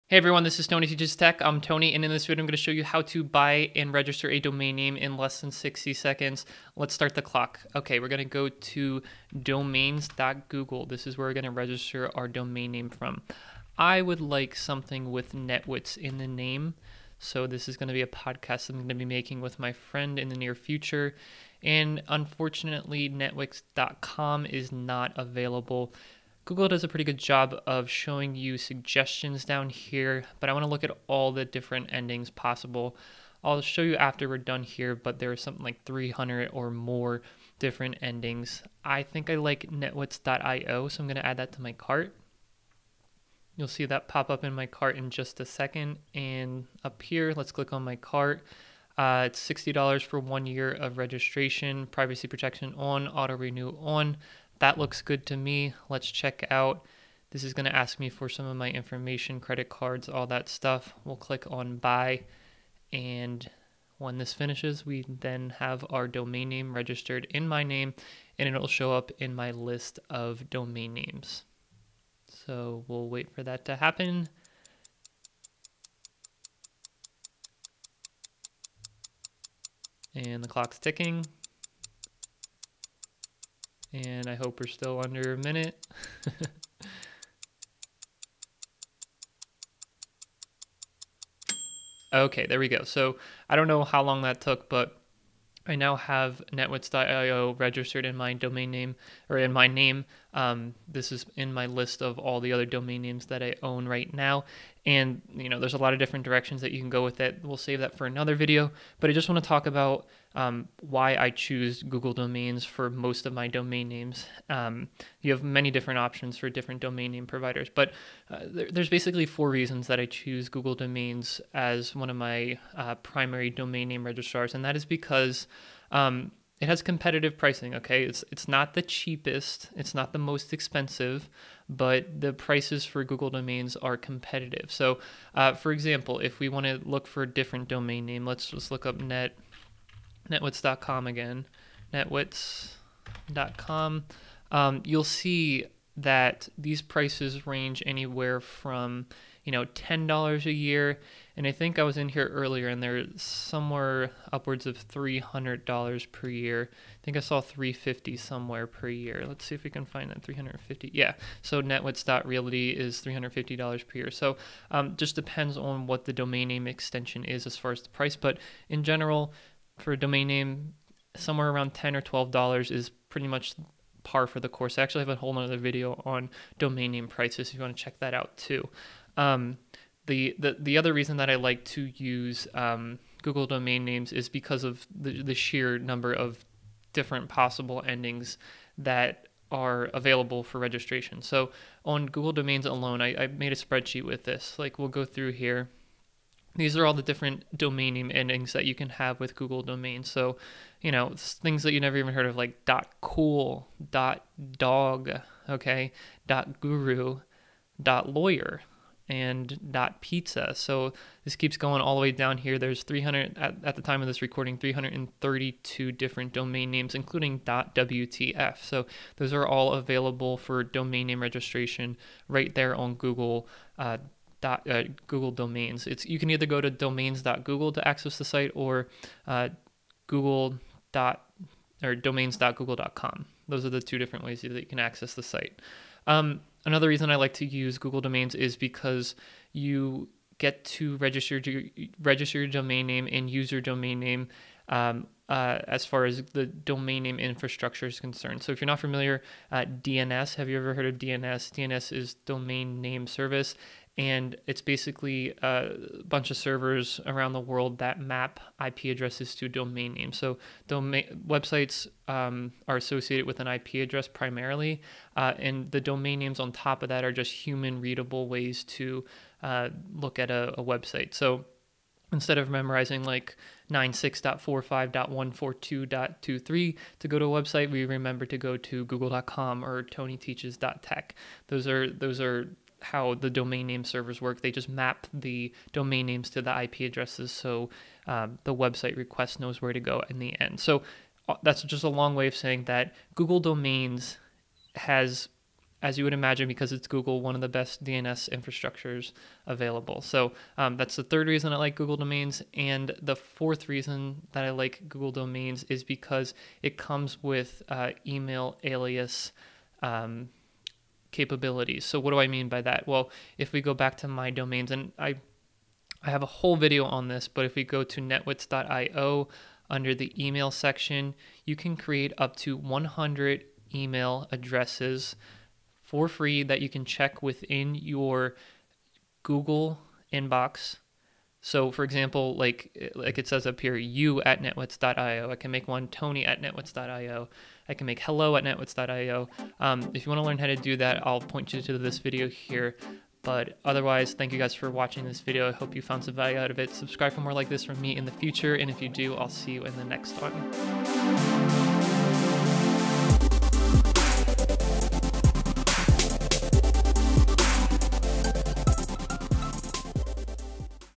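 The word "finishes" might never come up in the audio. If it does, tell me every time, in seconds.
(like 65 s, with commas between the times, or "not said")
64 s.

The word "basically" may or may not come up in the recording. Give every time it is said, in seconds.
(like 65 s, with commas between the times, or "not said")
118 s, 254 s.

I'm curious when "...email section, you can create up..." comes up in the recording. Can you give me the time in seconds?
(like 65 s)
320 s.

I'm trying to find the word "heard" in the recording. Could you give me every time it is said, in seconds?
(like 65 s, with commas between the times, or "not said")
202 s, 250 s.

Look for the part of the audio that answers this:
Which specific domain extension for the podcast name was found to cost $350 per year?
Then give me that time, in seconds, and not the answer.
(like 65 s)
161 s.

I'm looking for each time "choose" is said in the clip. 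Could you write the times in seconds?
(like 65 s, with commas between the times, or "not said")
111 s, 120 s.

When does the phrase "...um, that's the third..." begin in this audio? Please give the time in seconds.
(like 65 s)
300 s.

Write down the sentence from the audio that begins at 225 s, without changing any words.
It's you can either go to domains.google to access the site or uh, Google dot or domains.google.com.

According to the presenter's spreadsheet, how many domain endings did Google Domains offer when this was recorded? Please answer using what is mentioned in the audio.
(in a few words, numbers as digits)
332.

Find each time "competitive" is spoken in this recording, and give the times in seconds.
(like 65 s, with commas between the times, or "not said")
126 s, 133 s.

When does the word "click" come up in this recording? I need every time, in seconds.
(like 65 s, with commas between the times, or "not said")
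47 s, 61 s.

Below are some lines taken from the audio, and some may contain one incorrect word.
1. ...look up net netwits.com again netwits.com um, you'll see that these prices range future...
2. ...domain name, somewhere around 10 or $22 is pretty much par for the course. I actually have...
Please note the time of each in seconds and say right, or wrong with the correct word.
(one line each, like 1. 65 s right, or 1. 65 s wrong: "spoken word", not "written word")
1. 138 s wrong: "anywhere", not "future"
2. 169 s wrong: "12", not "22".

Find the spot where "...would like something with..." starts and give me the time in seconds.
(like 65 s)
14 s.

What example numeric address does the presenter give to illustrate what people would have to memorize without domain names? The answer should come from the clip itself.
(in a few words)
96.45.142.23.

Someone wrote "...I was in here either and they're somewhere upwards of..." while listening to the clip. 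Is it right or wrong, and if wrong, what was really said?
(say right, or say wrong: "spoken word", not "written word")
wrong: "earlier", not "either".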